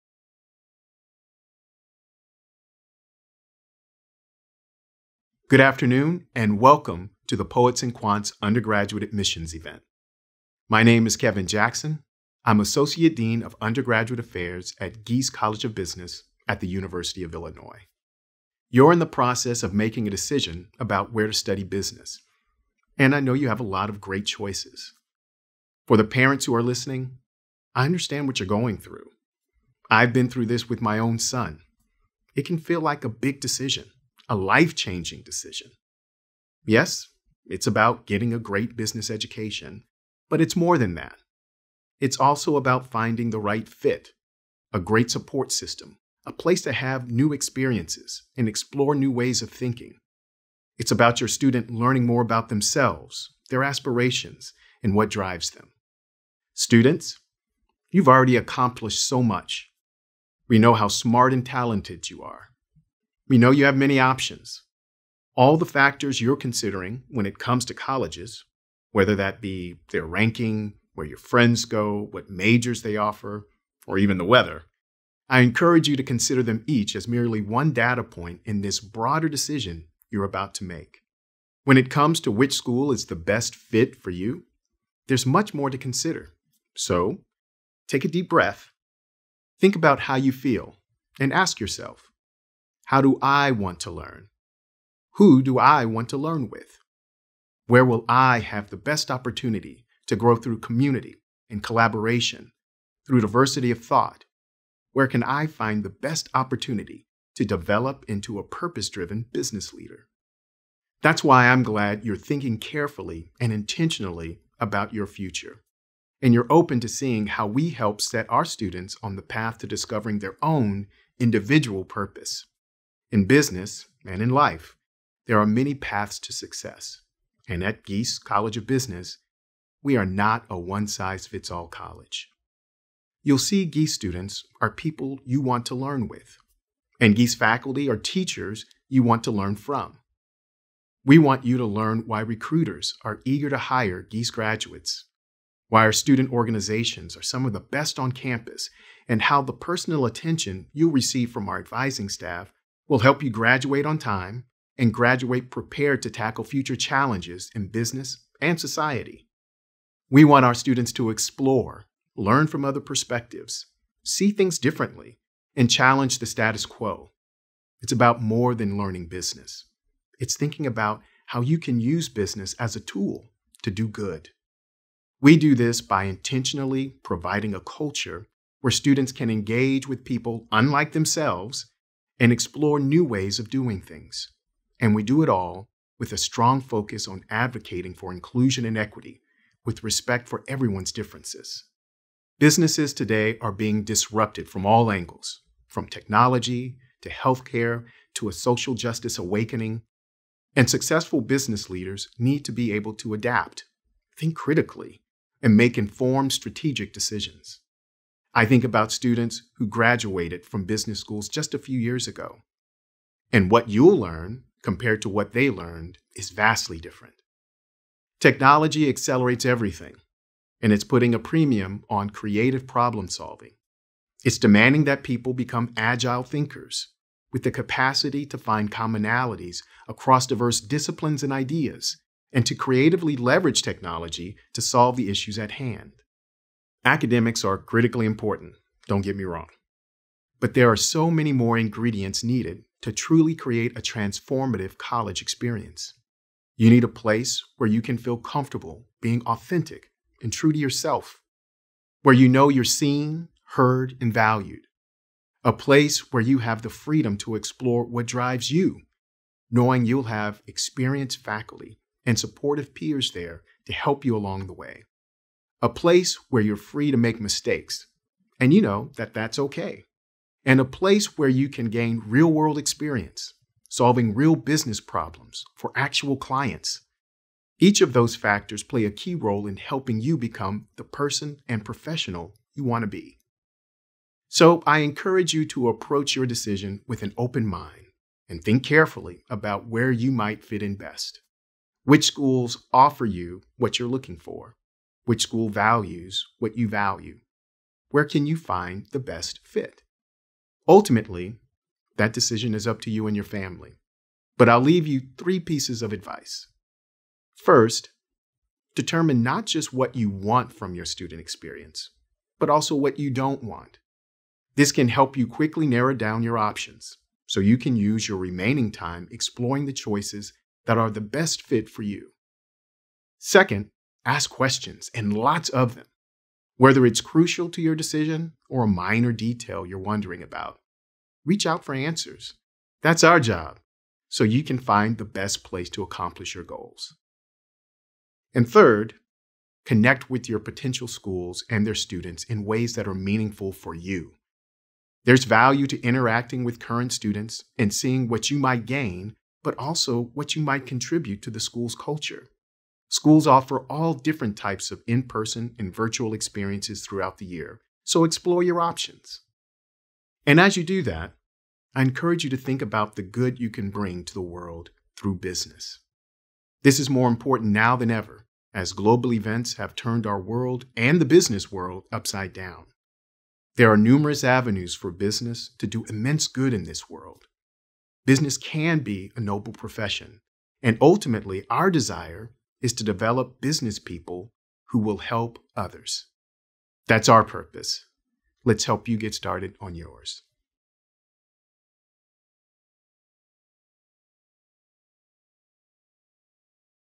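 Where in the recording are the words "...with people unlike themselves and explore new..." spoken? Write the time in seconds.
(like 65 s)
179 s.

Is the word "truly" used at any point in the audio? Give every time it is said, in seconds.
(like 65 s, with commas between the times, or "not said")
242 s.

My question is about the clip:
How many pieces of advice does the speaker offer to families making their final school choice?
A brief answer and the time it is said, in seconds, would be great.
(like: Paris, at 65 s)
3, at 305 s.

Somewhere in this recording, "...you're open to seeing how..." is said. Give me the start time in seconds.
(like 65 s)
116 s.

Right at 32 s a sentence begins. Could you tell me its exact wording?
It can feel like a big decision a life changing decision.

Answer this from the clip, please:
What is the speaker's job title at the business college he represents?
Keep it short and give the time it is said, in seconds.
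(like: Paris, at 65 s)
Associate Dean of Undergraduate Affairs, at 12 s.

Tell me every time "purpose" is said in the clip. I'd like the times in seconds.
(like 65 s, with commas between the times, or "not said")
108 s, 121 s, 387 s.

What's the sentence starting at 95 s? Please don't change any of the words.
Who do I want to learn with?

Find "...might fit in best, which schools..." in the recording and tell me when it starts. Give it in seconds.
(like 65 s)
290 s.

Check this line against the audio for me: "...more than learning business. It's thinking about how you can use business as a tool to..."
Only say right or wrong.
right.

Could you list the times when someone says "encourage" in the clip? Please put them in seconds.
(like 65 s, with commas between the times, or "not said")
75 s, 284 s, 361 s.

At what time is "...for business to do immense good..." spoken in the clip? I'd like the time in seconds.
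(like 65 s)
374 s.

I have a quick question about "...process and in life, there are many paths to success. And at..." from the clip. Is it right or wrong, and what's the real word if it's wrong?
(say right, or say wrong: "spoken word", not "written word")
wrong: "business", not "process".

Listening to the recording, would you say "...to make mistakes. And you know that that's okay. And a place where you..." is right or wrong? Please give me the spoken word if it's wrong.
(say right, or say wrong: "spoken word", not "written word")
right.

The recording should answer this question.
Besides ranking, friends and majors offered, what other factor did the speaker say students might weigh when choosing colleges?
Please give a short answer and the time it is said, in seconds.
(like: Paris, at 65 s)
the weather, at 74 s.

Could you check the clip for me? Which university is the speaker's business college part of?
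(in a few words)
University of Illinois.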